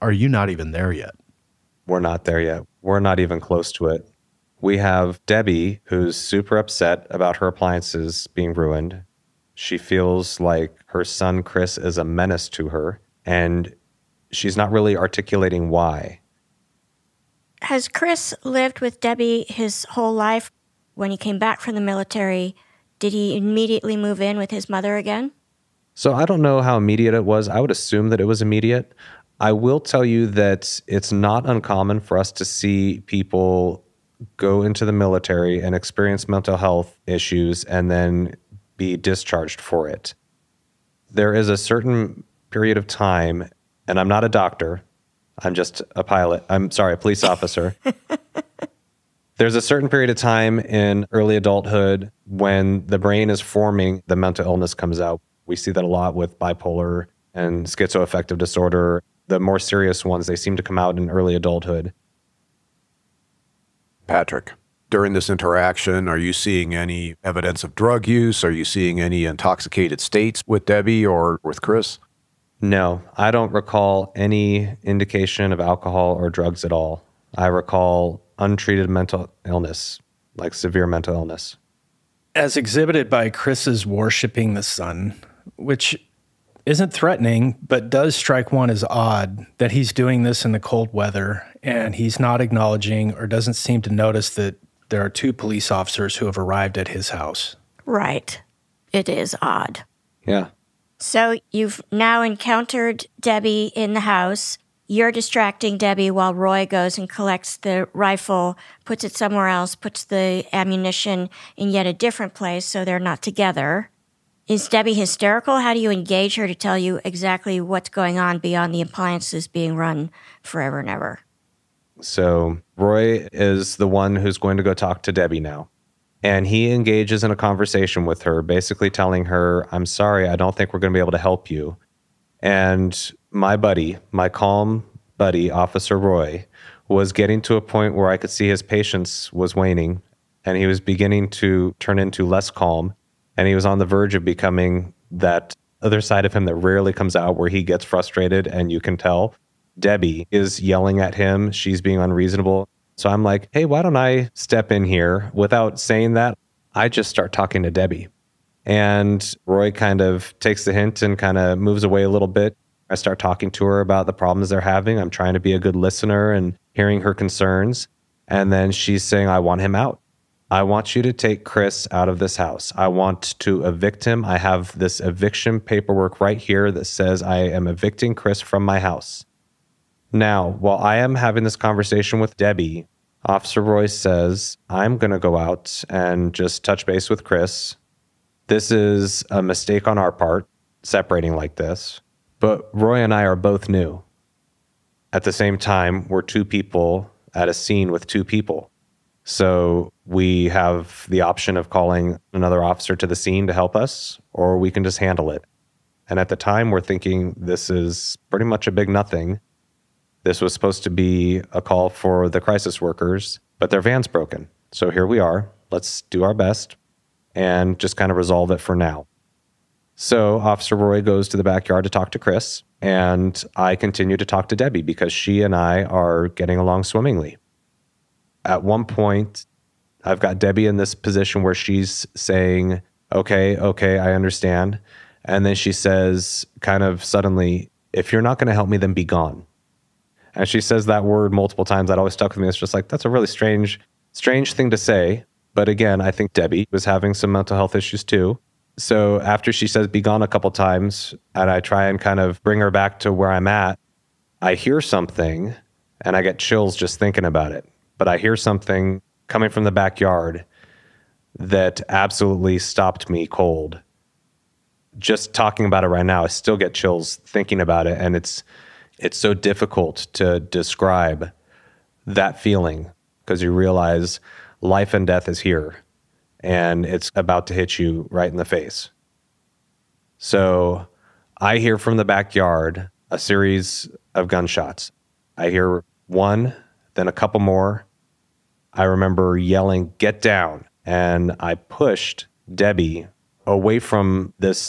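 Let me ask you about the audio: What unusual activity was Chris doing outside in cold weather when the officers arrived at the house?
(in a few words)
worshiping the sun.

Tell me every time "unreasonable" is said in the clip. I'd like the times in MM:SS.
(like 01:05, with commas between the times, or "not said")
02:31.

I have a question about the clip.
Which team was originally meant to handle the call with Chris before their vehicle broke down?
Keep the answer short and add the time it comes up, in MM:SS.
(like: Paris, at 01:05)
crisis workers, at 03:32.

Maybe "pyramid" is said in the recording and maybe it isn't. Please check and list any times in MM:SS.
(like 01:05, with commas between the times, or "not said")
not said.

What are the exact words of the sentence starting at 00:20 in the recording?
When he came back from the military, did he immediately move in with his mother again?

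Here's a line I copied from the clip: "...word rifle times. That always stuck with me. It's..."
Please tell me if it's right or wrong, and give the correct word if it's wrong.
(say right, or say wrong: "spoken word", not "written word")
wrong: "multiple", not "rifle".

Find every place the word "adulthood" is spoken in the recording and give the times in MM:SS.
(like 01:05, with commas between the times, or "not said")
00:51, 01:01.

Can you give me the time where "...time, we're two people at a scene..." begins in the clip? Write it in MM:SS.
03:15.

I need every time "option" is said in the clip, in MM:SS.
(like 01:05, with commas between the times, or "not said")
03:21.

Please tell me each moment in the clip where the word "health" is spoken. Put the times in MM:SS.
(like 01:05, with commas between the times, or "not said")
00:36, 04:07.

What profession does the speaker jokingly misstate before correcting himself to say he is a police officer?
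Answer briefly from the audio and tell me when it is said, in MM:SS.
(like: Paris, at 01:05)
pilot, at 00:46.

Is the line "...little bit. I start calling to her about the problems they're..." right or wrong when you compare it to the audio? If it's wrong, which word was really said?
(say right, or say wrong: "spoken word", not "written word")
wrong: "talking", not "calling".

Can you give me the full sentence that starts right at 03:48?
At one point, I've got Debbie in this position where she's saying, Okay, okay, I understand.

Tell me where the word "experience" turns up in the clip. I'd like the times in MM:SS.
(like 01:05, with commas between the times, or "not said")
00:35.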